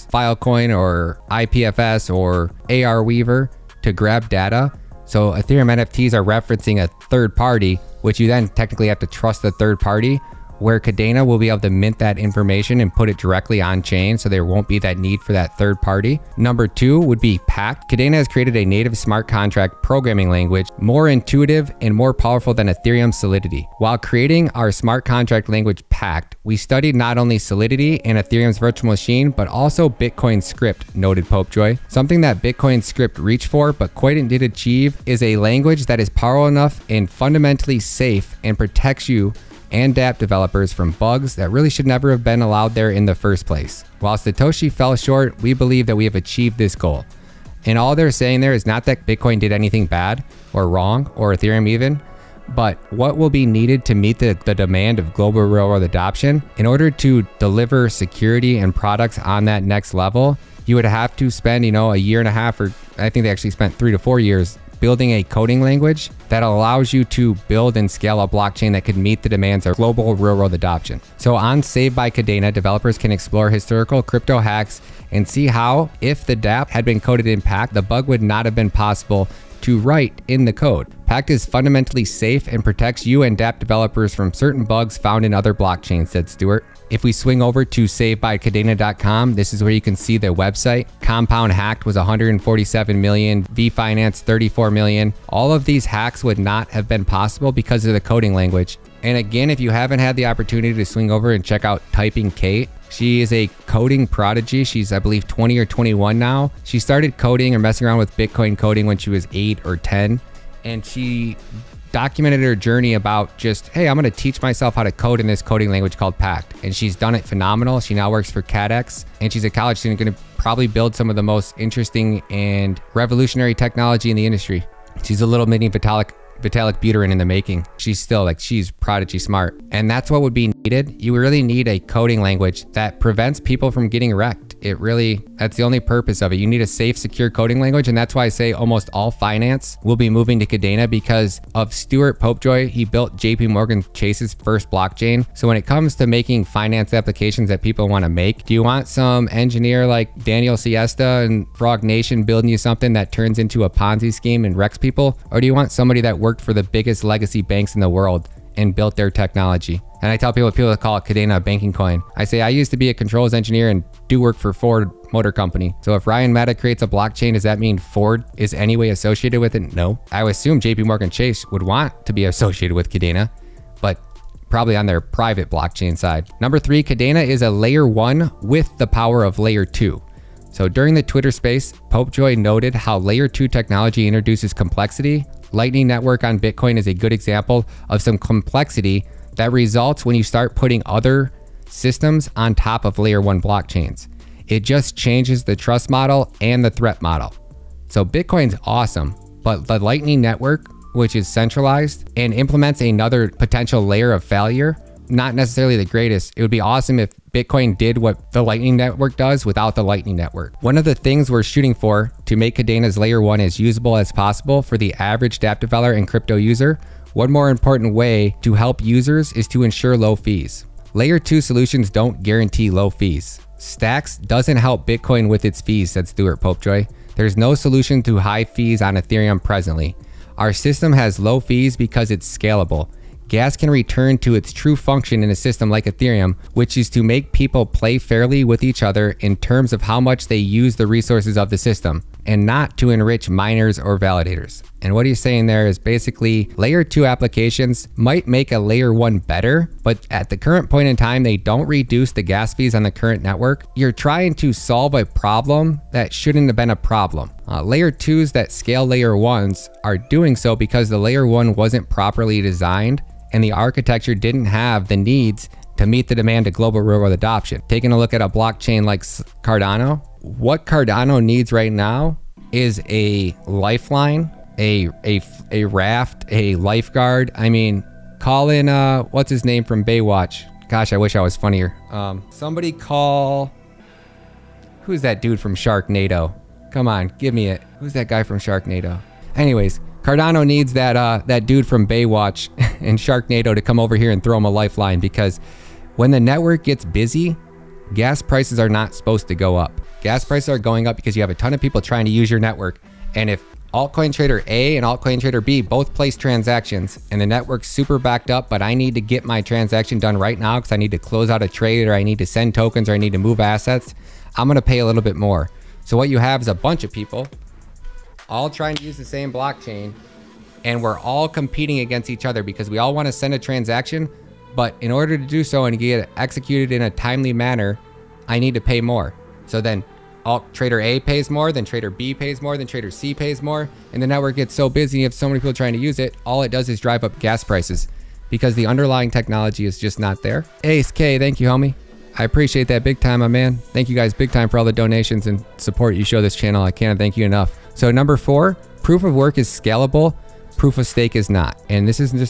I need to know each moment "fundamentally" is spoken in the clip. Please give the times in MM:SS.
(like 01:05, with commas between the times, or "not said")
00:37, 01:21.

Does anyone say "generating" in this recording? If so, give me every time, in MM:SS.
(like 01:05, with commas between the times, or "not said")
not said.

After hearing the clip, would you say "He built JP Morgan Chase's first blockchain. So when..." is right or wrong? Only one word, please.
right.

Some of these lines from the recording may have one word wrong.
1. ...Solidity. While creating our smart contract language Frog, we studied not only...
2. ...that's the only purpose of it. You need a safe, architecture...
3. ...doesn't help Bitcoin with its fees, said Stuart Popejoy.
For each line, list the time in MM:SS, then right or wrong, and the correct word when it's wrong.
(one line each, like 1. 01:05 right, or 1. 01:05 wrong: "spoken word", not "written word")
1. 00:23 wrong: "Pact", not "Frog"
2. 02:15 wrong: "secure", not "architecture"
3. 03:44 right.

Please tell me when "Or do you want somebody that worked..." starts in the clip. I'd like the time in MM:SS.
02:35.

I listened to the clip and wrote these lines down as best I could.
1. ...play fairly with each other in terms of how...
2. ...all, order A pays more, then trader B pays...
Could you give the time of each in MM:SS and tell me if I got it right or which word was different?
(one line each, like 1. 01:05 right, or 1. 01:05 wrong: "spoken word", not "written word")
1. 03:57 right
2. 05:30 wrong: "trader", not "order".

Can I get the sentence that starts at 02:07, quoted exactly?
She's still like, she's prodigy smart.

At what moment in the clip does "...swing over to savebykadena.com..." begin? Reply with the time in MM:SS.
01:27.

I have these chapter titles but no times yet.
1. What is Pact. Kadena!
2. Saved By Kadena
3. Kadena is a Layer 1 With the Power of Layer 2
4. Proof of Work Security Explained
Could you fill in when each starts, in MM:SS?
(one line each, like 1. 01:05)
1. 00:43
2. 02:13
3. 03:13
4. 05:44.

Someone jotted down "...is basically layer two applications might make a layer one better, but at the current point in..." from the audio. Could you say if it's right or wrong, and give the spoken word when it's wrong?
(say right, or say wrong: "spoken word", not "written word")
right.